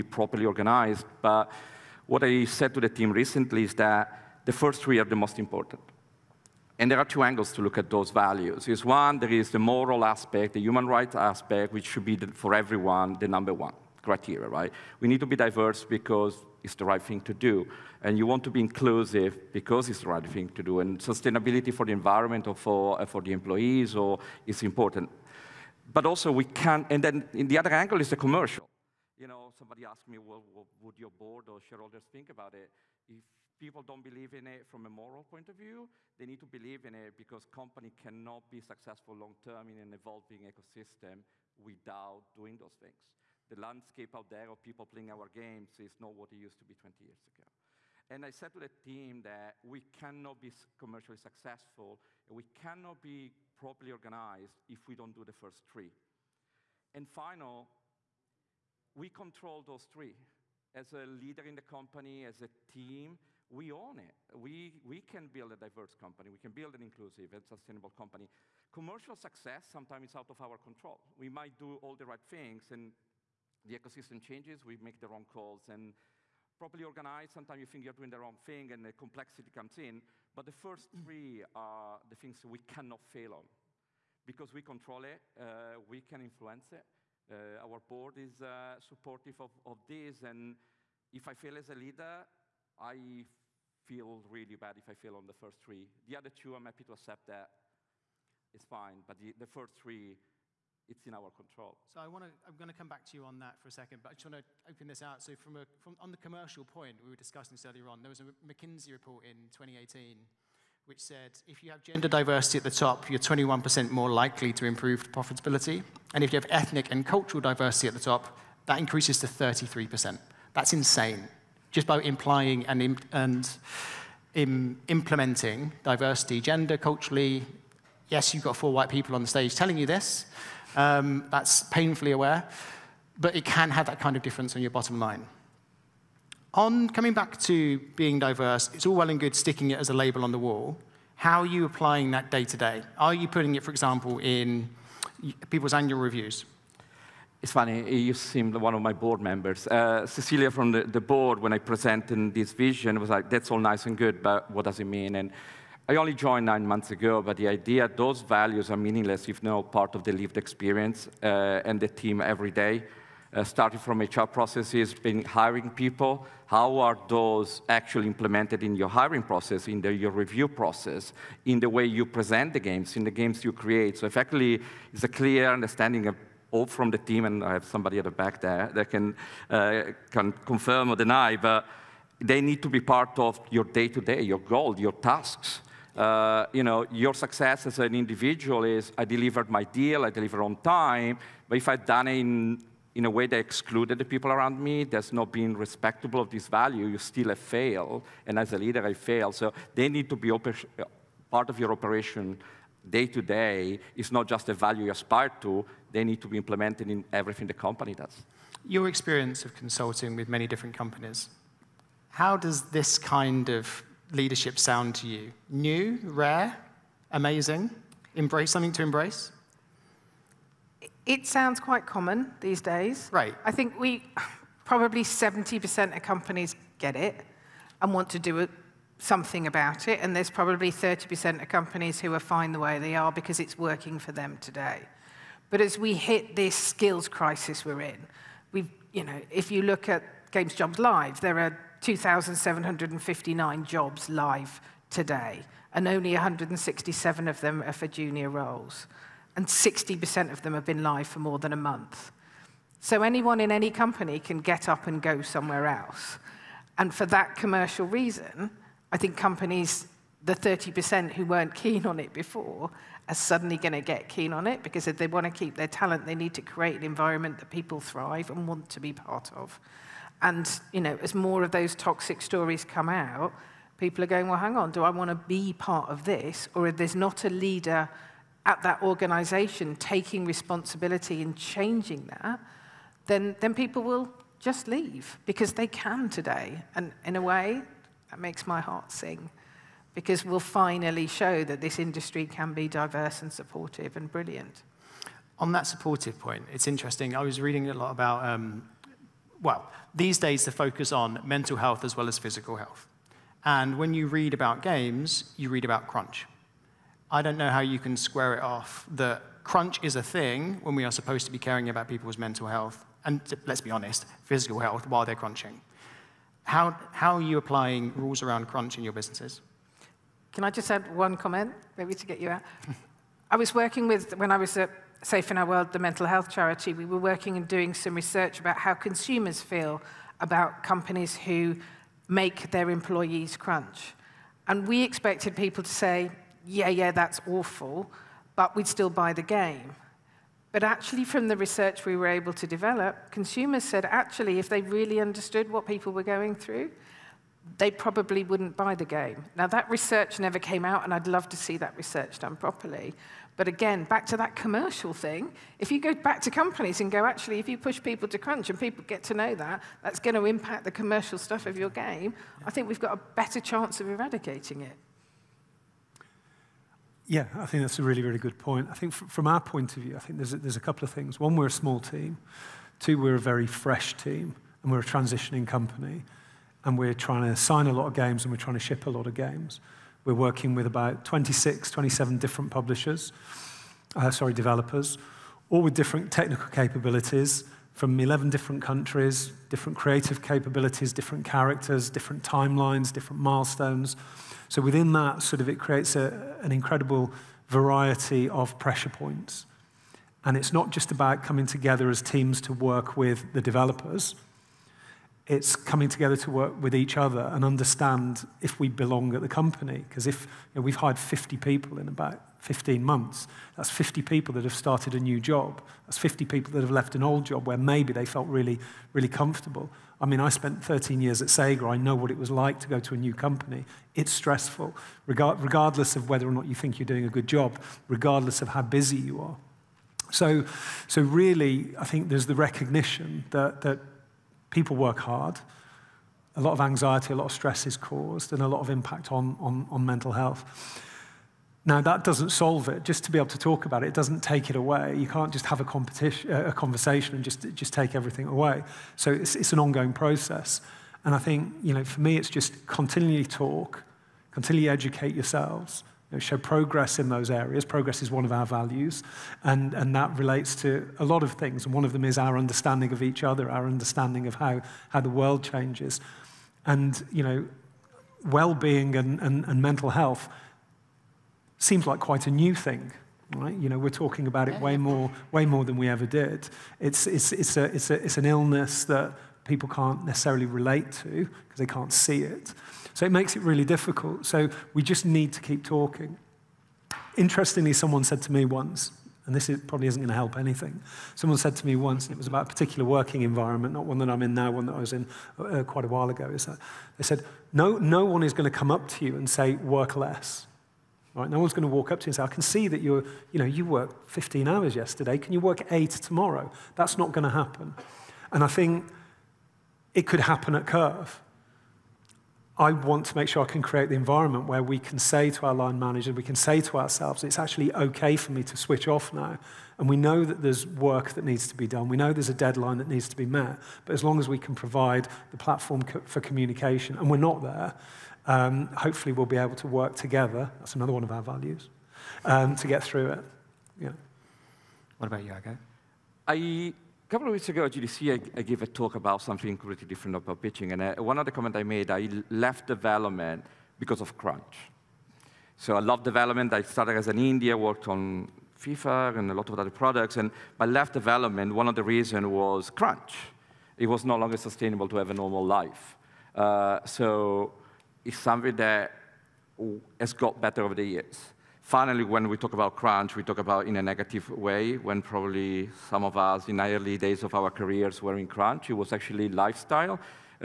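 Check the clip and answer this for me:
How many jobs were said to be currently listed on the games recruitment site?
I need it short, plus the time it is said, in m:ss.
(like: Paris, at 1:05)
2,759, at 4:01.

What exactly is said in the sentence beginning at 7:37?
Progress is one of our values, and, and that relates to a lot of things.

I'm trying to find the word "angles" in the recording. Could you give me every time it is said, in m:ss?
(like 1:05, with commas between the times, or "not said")
0:07, 0:27.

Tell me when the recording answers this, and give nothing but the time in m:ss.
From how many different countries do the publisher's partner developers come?
6:27.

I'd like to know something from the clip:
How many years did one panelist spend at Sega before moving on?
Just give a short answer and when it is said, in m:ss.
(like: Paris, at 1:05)
13, at 7:00.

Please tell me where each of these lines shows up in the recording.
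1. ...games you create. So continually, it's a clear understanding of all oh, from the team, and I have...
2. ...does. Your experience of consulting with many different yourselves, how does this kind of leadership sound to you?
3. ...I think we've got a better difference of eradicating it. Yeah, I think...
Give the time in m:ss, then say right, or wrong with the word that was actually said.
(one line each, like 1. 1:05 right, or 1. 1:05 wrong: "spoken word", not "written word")
1. 2:53 wrong: "effectively", not "continually"
2. 3:27 wrong: "companies", not "yourselves"
3. 6:02 wrong: "chance", not "difference".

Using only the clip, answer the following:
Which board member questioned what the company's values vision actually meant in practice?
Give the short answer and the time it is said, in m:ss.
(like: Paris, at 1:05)
Cecilia, at 2:30.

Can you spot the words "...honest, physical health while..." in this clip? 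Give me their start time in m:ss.
5:13.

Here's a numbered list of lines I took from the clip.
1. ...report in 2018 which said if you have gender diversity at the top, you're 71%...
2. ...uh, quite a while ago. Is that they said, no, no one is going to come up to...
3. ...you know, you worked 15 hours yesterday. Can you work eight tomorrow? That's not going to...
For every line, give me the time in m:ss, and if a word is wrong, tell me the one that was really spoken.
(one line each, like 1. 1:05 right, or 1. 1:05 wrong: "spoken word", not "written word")
1. 1:48 wrong: "21", not "71"
2. 8:15 right
3. 8:23 right.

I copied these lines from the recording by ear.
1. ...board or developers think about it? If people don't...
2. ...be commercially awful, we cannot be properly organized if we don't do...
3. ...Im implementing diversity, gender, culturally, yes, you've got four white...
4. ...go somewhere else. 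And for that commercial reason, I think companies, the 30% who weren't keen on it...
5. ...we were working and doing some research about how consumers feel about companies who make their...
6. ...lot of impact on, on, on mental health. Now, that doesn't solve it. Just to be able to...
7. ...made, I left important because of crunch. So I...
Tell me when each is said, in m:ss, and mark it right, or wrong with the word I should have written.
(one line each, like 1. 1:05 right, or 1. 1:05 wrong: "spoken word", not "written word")
1. 0:31 wrong: "shareholders", not "developers"
2. 0:50 wrong: "successful", not "awful"
3. 2:04 right
4. 4:14 right
5. 5:26 right
6. 7:18 right
7. 9:01 wrong: "development", not "important".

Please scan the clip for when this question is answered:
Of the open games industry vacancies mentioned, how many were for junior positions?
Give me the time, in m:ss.
4:06.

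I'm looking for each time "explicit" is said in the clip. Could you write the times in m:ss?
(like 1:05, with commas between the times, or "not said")
not said.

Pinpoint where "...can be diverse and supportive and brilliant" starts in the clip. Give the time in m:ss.
4:52.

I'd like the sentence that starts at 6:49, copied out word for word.
Because if you know, we've hired 50 people in about 15 months, that's 50 people that have started a new job.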